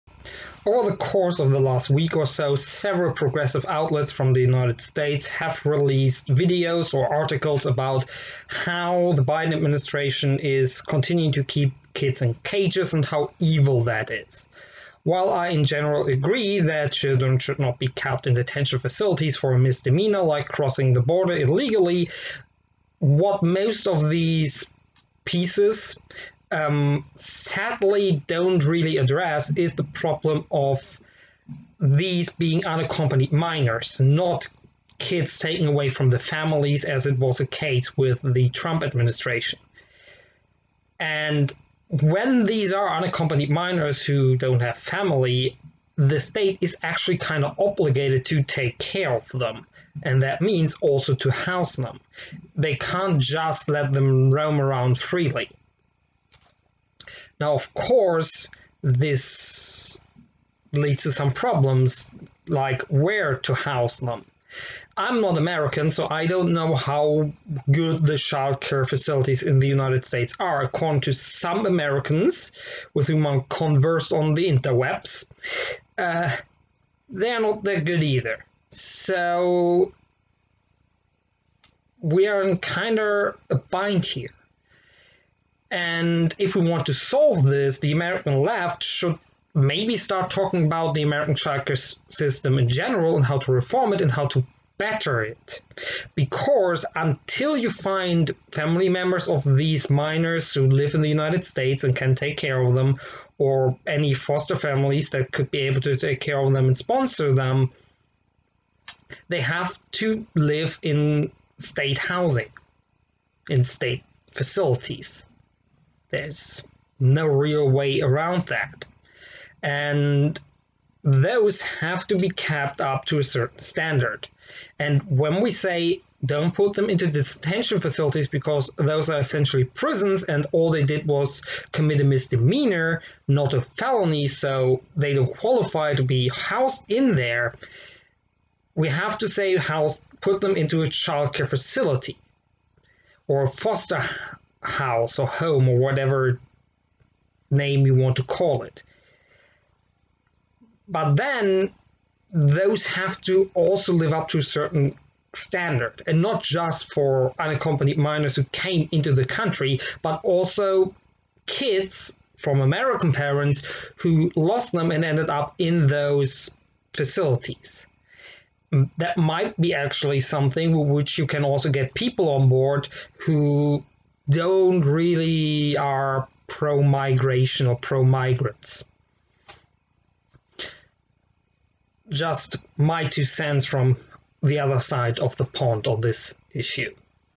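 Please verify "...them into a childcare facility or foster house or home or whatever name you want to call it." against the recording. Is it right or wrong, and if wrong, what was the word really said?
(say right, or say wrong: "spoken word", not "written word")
right.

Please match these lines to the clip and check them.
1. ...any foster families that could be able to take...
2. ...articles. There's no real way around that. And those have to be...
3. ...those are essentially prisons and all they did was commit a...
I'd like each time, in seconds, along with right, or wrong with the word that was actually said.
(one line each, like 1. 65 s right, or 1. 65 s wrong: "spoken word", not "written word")
1. 103 s right
2. 114 s wrong: "facilities", not "articles"
3. 128 s right.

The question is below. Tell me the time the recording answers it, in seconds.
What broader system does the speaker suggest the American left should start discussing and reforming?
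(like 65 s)
91 s.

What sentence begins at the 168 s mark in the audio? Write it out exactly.
That might be actually something which you can also get people on board who don't really are pro migration or pro migrants.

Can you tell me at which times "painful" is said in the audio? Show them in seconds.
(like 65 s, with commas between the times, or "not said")
not said.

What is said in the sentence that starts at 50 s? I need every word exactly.
And that means also to house them.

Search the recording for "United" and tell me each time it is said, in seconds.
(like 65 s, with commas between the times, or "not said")
4 s, 69 s, 101 s.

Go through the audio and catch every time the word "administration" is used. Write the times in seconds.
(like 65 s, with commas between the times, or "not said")
9 s, 38 s.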